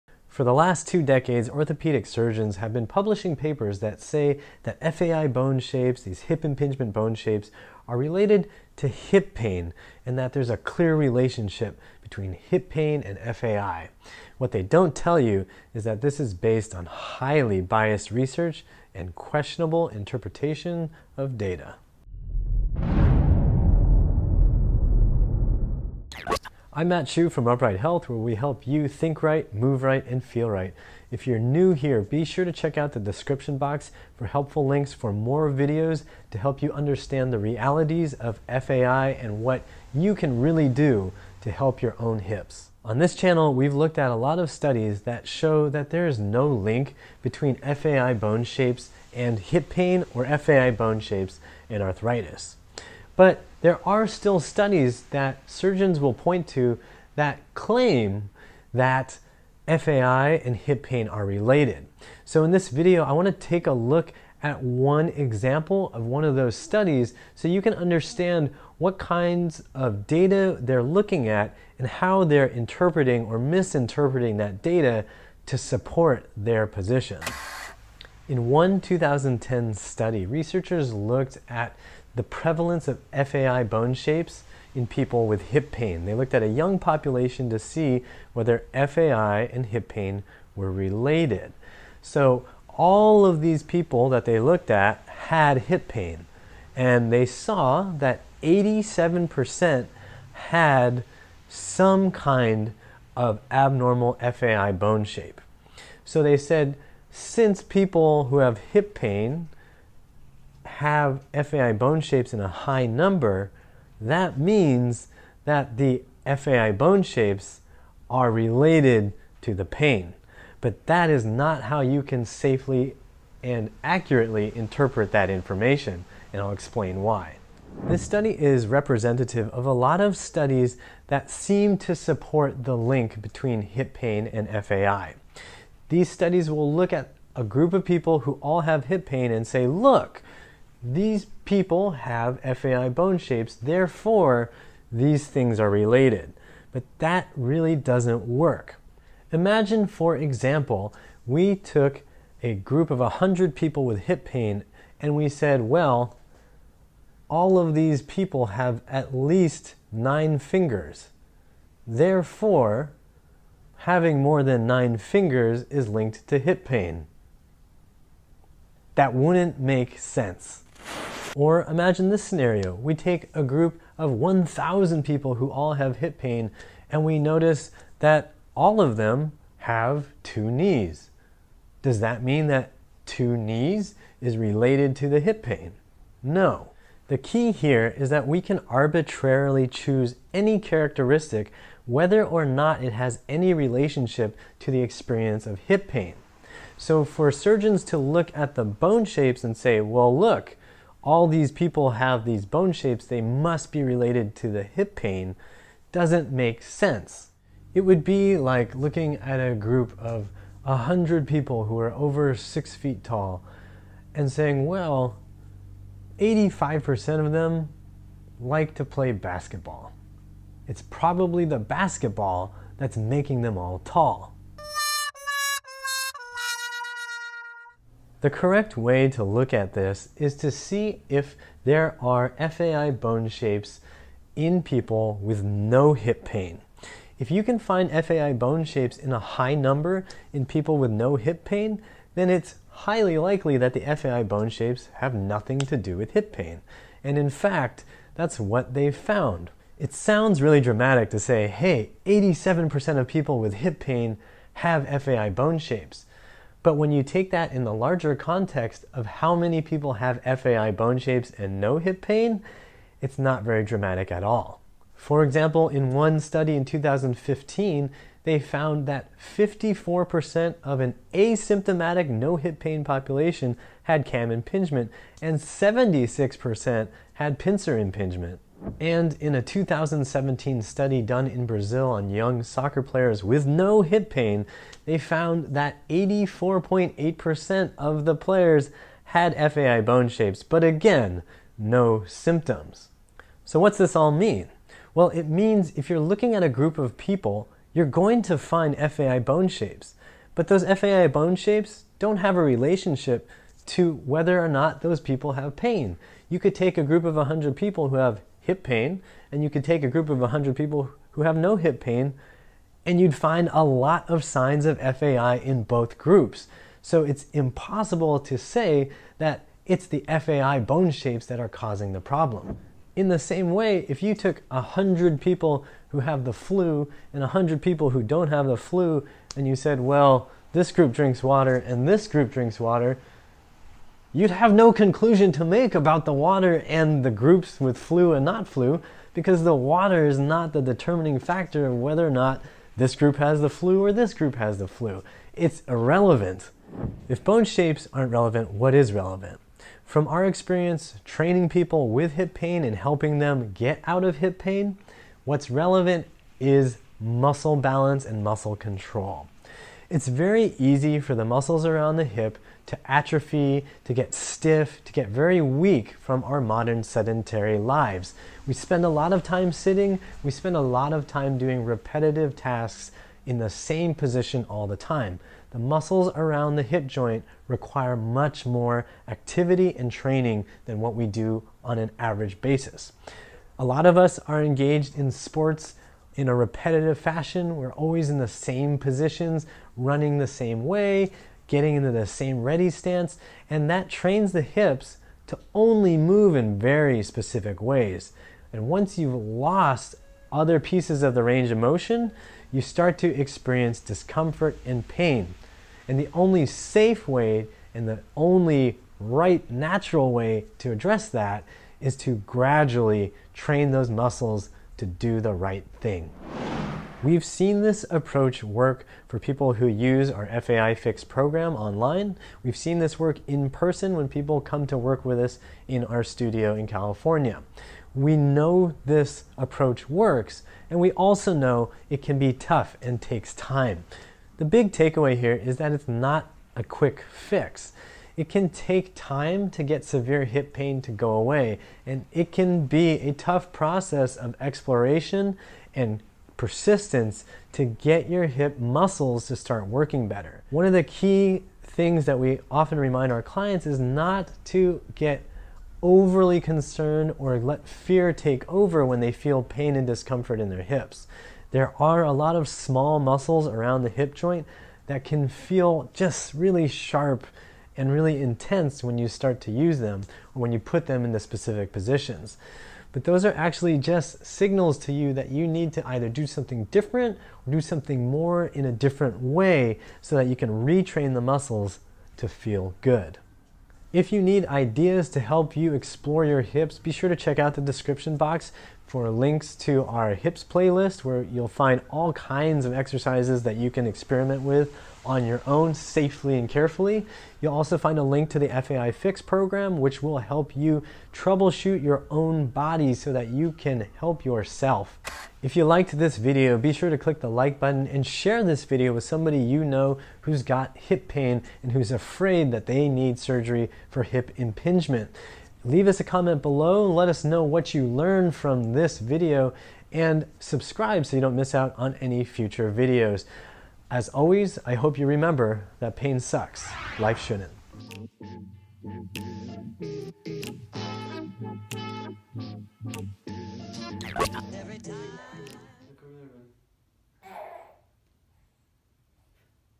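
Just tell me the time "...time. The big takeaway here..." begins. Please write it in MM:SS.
07:13.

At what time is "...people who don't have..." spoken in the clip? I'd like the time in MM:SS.
05:27.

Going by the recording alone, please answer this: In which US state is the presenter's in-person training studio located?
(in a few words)
California.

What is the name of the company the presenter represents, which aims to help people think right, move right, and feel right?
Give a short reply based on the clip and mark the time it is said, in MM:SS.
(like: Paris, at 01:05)
Upright Health, at 00:27.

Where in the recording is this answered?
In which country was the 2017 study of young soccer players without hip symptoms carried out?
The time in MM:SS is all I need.
04:41.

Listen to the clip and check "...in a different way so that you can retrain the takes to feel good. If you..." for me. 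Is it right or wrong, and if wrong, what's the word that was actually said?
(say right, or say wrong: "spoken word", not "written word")
wrong: "muscles", not "takes".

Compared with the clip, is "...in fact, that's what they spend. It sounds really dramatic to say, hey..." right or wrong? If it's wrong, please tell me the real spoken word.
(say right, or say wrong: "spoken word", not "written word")
wrong: "found", not "spend".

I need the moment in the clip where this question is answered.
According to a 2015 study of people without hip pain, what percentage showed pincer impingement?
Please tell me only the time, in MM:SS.
04:35.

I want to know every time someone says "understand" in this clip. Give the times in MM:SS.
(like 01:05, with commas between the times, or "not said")
00:36, 01:07.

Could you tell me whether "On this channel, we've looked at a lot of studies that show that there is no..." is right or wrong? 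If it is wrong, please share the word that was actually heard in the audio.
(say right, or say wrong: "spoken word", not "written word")
right.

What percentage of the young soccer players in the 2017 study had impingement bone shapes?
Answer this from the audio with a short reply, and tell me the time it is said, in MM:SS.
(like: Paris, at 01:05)
84.8%, at 04:45.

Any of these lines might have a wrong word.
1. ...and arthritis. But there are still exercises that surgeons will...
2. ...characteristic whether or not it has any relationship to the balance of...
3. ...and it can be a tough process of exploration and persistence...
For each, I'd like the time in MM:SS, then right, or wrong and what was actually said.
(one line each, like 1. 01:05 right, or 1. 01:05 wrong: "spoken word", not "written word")
1. 00:51 wrong: "studies", not "exercises"
2. 03:10 wrong: "experience", not "balance"
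3. 07:21 right.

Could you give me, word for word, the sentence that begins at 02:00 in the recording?
But that is not how you can safely and accurately interpret that information, and I'll explain why.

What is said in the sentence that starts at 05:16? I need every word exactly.
So it's impossible to say that it's the FAI bone shapes that are causing the problem.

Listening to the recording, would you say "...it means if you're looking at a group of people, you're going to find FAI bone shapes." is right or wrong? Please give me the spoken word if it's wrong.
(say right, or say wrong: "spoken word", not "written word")
right.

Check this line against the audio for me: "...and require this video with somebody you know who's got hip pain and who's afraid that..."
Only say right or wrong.
wrong.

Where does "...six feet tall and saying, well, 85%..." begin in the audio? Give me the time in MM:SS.
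03:32.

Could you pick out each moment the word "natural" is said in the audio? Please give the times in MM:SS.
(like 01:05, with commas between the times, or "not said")
06:49.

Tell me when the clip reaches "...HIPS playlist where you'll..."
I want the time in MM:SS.
08:10.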